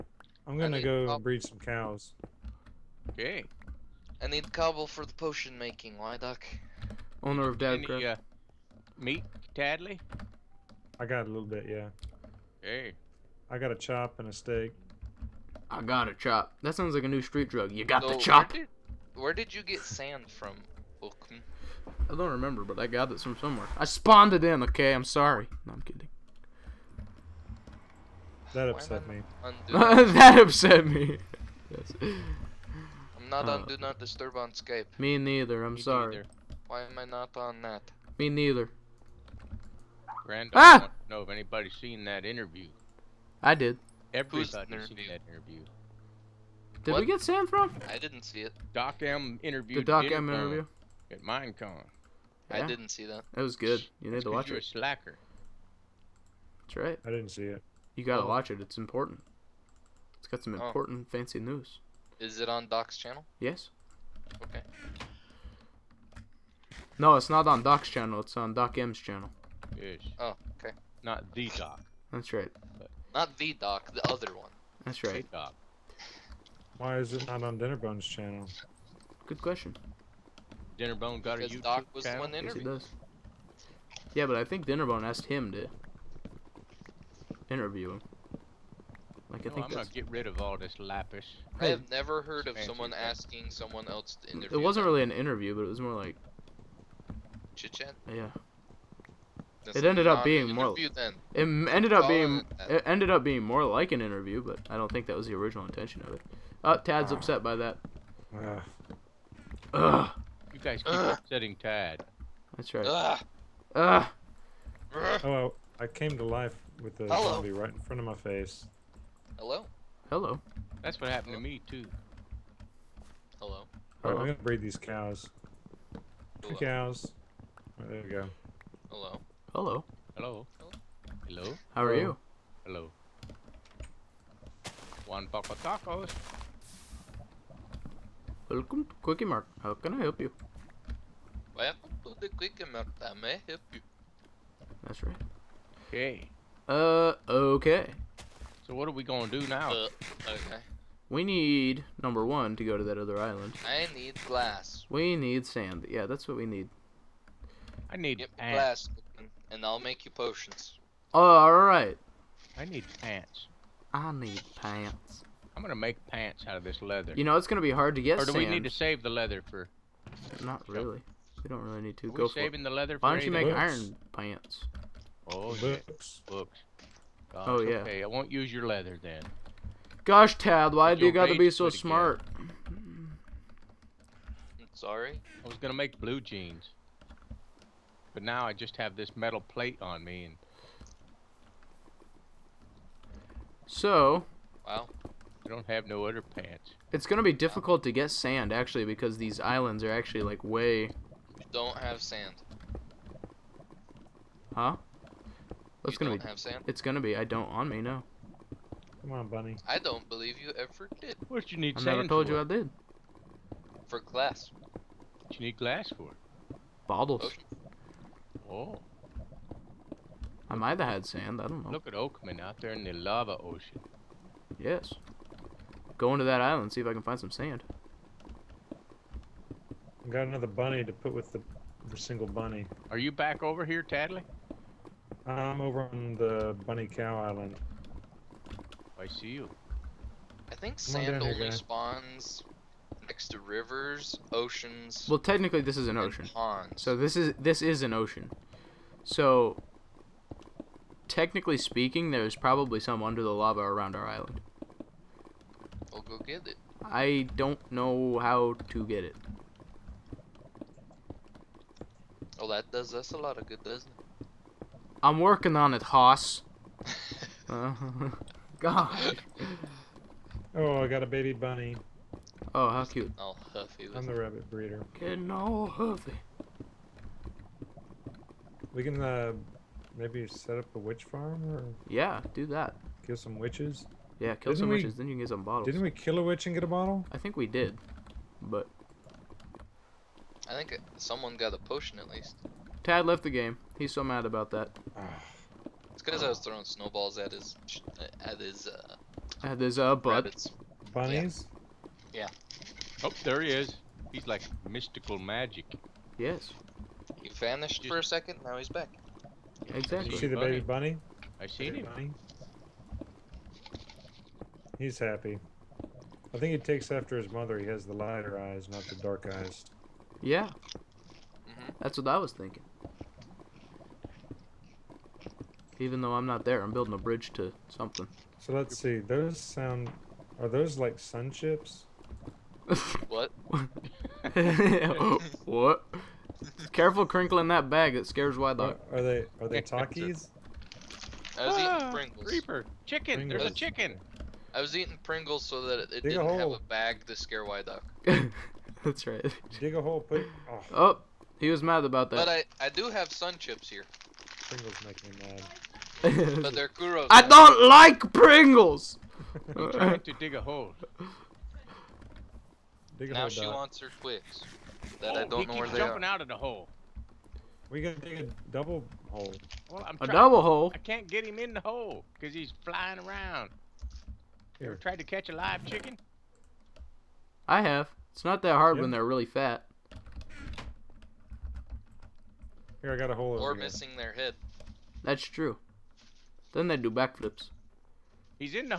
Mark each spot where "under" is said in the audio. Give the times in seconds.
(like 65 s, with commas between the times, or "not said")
253 s.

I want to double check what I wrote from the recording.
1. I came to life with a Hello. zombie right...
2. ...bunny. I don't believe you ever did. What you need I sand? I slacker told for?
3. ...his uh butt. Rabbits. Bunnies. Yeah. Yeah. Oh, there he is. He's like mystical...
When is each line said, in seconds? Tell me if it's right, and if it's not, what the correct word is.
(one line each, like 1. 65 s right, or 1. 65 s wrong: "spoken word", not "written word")
1. 115 s right
2. 209 s wrong: "never", not "slacker"
3. 299 s right.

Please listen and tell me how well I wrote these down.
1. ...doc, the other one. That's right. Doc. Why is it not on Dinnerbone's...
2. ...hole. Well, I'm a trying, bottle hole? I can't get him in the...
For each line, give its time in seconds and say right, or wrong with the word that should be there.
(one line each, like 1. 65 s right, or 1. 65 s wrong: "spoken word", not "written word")
1. 73 s right
2. 369 s wrong: "double", not "bottle".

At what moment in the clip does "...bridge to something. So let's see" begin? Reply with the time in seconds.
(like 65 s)
326 s.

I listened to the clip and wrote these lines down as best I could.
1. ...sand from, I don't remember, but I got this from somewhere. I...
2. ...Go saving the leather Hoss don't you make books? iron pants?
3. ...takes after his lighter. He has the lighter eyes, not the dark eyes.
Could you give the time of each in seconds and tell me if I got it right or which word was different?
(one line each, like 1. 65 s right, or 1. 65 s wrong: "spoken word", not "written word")
1. 19 s right
2. 172 s wrong: "Why", not "Hoss"
3. 316 s wrong: "mother", not "lighter".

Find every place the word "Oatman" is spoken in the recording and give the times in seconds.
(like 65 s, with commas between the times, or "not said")
221 s.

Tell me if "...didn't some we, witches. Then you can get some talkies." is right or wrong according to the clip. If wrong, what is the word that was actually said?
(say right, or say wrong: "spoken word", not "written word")
wrong: "bottles", not "talkies".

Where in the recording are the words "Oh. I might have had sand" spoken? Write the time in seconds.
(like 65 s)
218 s.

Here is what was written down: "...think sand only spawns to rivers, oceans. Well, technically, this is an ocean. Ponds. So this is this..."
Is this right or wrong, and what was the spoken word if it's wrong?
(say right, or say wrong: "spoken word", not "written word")
right.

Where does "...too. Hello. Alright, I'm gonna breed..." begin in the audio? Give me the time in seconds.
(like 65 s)
121 s.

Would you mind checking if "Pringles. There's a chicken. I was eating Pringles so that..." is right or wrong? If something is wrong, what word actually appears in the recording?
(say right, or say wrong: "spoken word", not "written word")
right.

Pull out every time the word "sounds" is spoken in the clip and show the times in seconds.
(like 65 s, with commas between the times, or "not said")
16 s, 329 s.